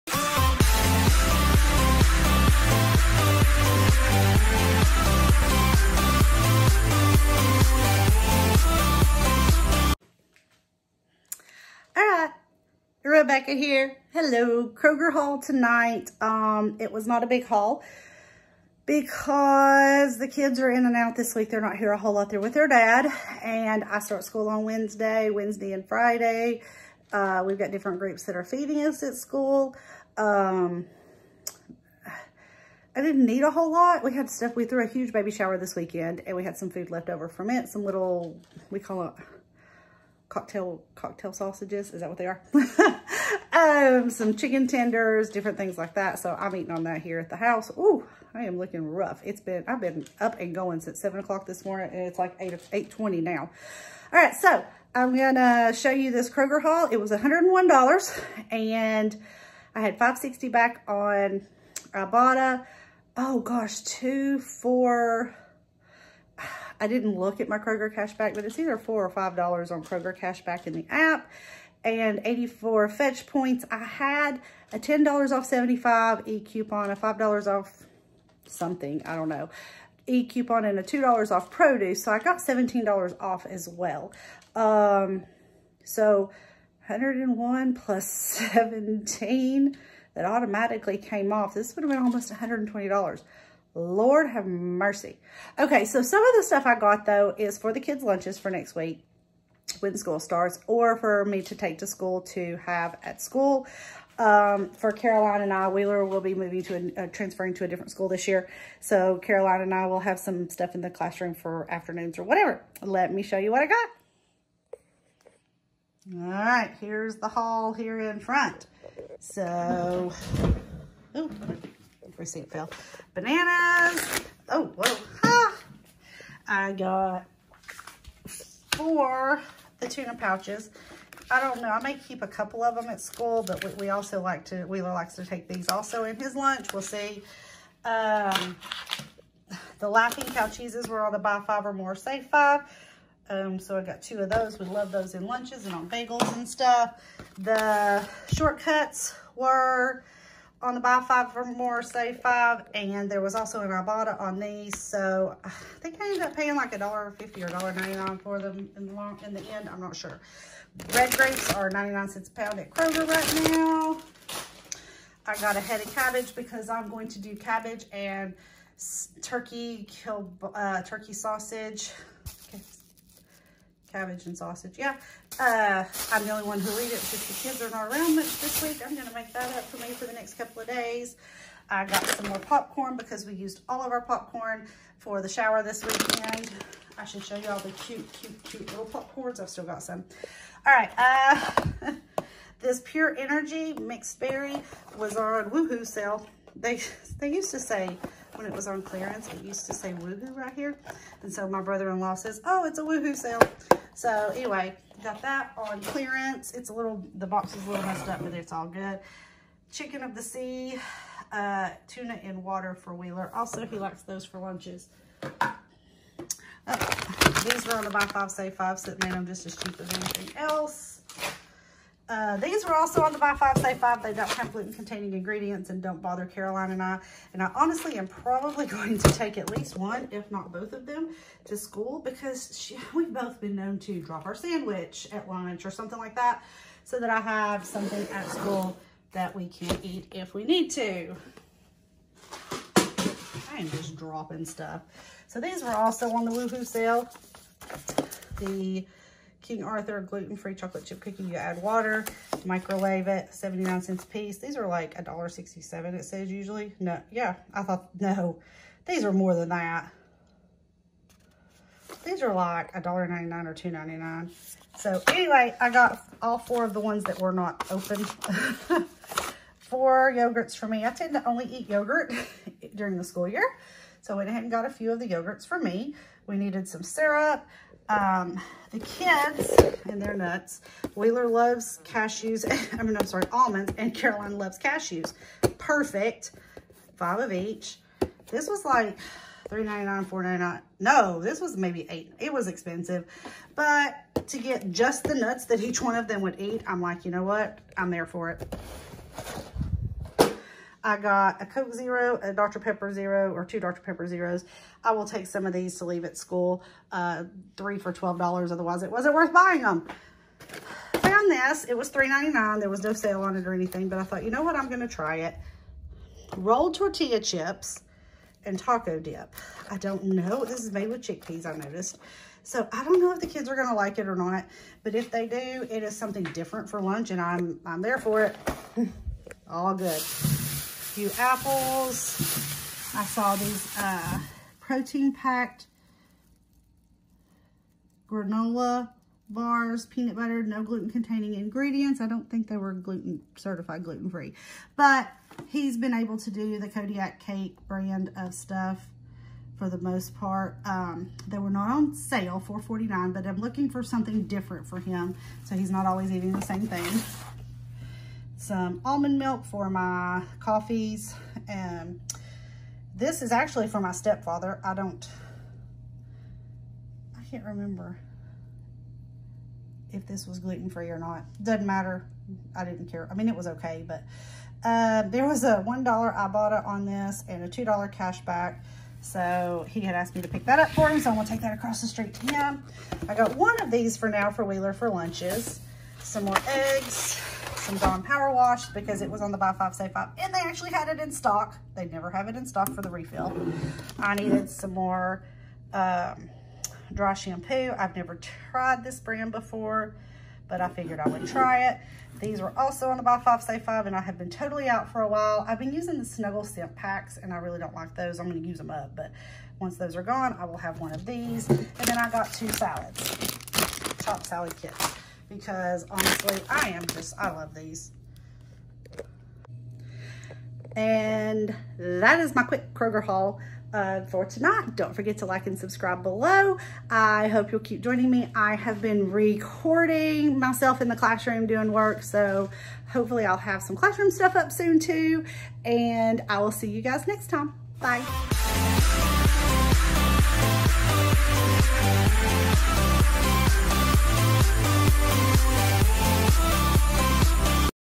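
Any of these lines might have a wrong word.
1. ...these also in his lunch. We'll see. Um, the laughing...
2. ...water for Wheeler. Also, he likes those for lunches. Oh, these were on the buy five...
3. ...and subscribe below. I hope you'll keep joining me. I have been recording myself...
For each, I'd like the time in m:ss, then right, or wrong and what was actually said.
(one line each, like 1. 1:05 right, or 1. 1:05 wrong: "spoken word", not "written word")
1. 2:15 right
2. 3:32 right
3. 7:05 right.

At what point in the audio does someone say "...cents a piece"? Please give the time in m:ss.
4:13.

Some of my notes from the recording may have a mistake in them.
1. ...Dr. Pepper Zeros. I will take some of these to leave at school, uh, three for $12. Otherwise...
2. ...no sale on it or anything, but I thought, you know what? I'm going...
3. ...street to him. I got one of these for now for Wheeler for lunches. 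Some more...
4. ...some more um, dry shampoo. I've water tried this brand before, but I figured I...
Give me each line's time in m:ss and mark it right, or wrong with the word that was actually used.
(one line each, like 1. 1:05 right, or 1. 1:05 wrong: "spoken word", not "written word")
1. 5:03 right
2. 5:12 right
3. 6:21 right
4. 6:34 wrong: "never", not "water".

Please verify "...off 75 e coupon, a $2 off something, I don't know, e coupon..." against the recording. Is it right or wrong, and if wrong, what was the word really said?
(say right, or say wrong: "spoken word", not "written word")
wrong: "5", not "2".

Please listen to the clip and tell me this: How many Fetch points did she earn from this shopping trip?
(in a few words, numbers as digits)
84.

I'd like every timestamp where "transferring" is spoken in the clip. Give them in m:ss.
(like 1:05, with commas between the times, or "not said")
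1:47.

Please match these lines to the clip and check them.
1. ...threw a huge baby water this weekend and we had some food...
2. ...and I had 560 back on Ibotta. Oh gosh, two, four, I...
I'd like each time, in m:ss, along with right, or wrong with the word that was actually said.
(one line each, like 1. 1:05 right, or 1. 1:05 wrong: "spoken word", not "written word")
1. 0:34 wrong: "shower", not "water"
2. 0:58 right.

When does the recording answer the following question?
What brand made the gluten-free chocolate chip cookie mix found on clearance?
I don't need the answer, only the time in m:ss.
4:09.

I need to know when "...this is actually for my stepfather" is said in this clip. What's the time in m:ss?
6:02.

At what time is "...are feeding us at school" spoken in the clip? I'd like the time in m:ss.
0:28.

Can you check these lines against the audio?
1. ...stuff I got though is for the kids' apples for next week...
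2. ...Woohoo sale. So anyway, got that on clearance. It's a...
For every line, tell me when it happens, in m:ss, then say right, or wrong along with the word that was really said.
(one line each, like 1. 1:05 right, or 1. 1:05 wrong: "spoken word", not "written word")
1. 1:36 wrong: "lunches", not "apples"
2. 3:22 right.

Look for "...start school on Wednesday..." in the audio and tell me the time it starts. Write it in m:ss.
0:23.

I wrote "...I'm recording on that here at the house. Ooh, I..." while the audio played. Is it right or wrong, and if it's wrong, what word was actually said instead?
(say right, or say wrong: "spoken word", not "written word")
wrong: "eating", not "recording".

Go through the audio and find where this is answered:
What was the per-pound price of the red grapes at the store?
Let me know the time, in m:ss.
2:41.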